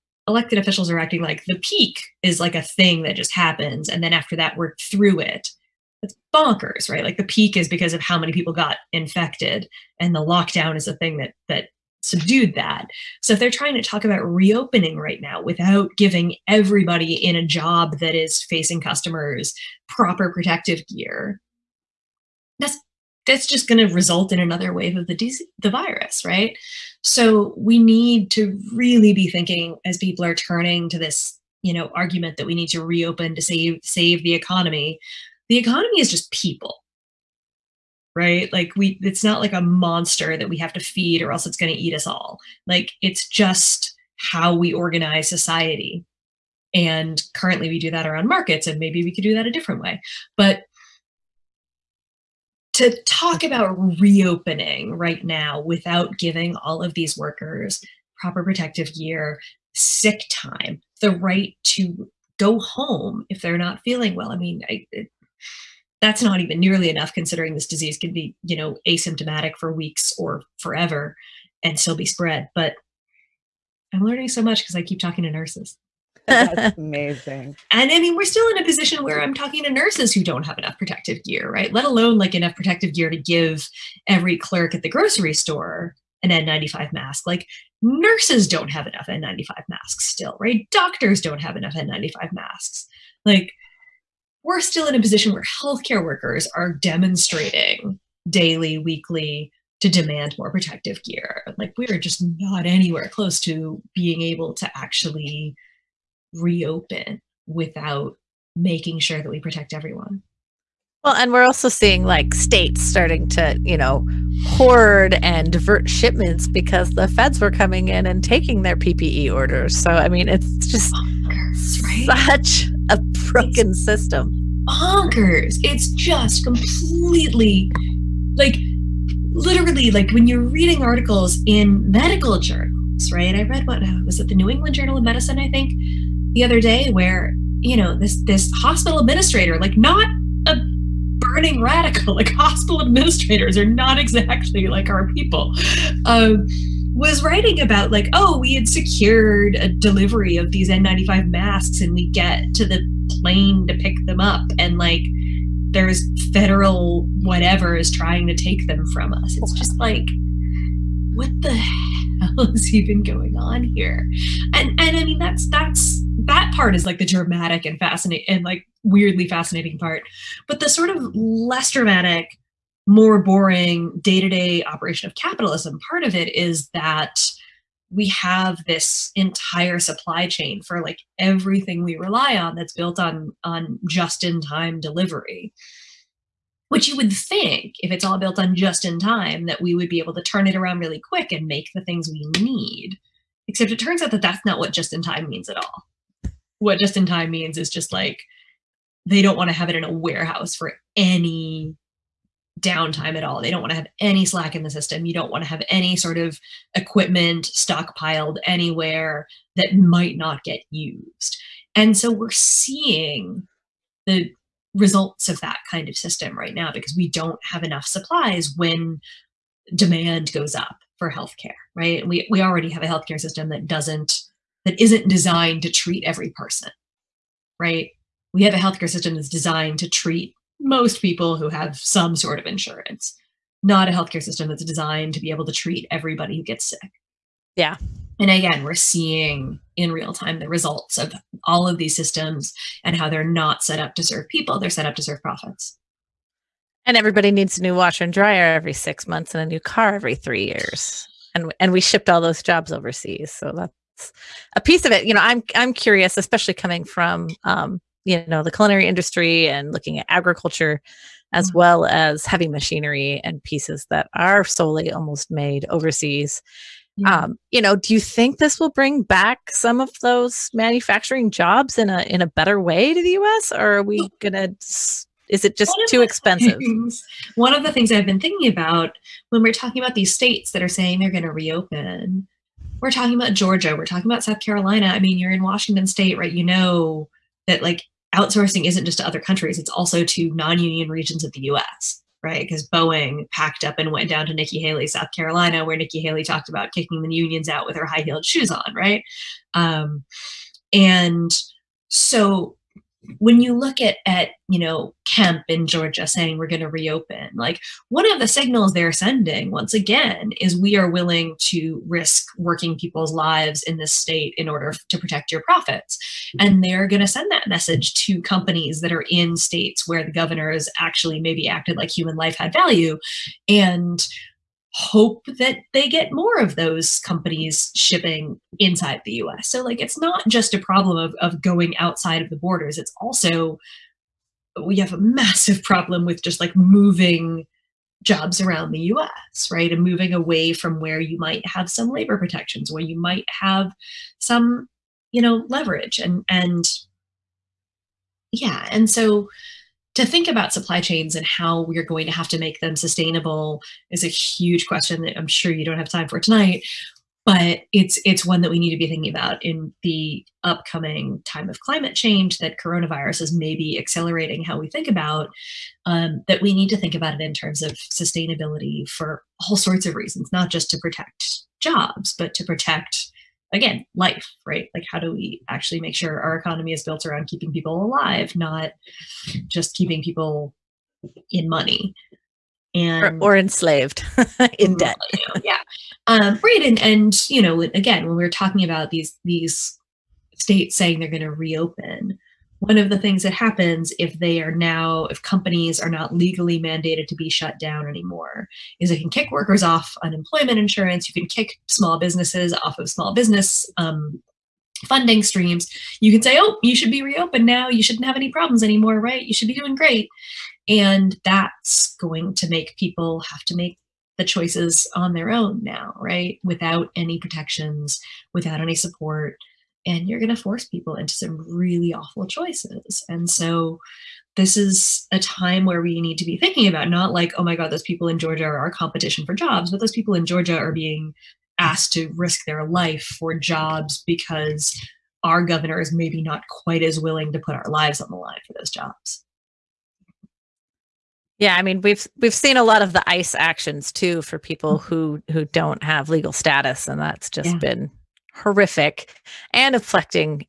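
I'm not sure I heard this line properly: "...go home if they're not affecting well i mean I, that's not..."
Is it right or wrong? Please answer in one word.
wrong.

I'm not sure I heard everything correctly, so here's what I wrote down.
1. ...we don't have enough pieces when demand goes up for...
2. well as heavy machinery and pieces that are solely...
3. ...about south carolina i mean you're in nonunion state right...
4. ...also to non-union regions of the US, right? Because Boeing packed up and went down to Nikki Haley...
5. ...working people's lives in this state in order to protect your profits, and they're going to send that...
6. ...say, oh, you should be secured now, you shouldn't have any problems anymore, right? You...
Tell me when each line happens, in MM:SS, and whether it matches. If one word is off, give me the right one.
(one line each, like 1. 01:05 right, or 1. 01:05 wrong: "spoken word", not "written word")
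1. 03:36 wrong: "supplies", not "pieces"
2. 04:21 right
3. 04:44 wrong: "washington", not "nonunion"
4. 04:49 right
5. 05:12 right
6. 06:46 wrong: "reopened", not "secured".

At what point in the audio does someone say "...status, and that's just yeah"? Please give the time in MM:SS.
07:26.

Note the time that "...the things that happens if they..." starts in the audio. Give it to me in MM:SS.
06:32.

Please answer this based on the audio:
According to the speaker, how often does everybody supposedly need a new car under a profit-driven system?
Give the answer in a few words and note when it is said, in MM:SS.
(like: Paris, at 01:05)
every 3 years, at 04:09.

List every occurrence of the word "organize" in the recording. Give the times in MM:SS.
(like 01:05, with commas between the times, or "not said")
00:44.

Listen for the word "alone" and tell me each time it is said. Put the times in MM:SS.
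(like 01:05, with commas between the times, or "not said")
01:21.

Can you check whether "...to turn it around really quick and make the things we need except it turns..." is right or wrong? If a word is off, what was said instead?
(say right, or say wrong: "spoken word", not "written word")
right.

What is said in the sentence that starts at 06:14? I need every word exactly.
Like, how do we actually make sure our economy is built around keeping people alive, not just keeping people in money?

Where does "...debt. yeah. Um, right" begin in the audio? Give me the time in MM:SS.
06:24.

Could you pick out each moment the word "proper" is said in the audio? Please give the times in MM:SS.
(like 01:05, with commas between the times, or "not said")
00:19, 00:58.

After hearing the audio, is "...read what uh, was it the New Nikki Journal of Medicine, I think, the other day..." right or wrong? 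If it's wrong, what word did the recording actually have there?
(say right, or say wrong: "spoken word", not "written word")
wrong: "England", not "Nikki".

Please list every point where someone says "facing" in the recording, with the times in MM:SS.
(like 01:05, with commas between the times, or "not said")
00:18.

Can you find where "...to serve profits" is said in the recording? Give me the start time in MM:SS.
04:04.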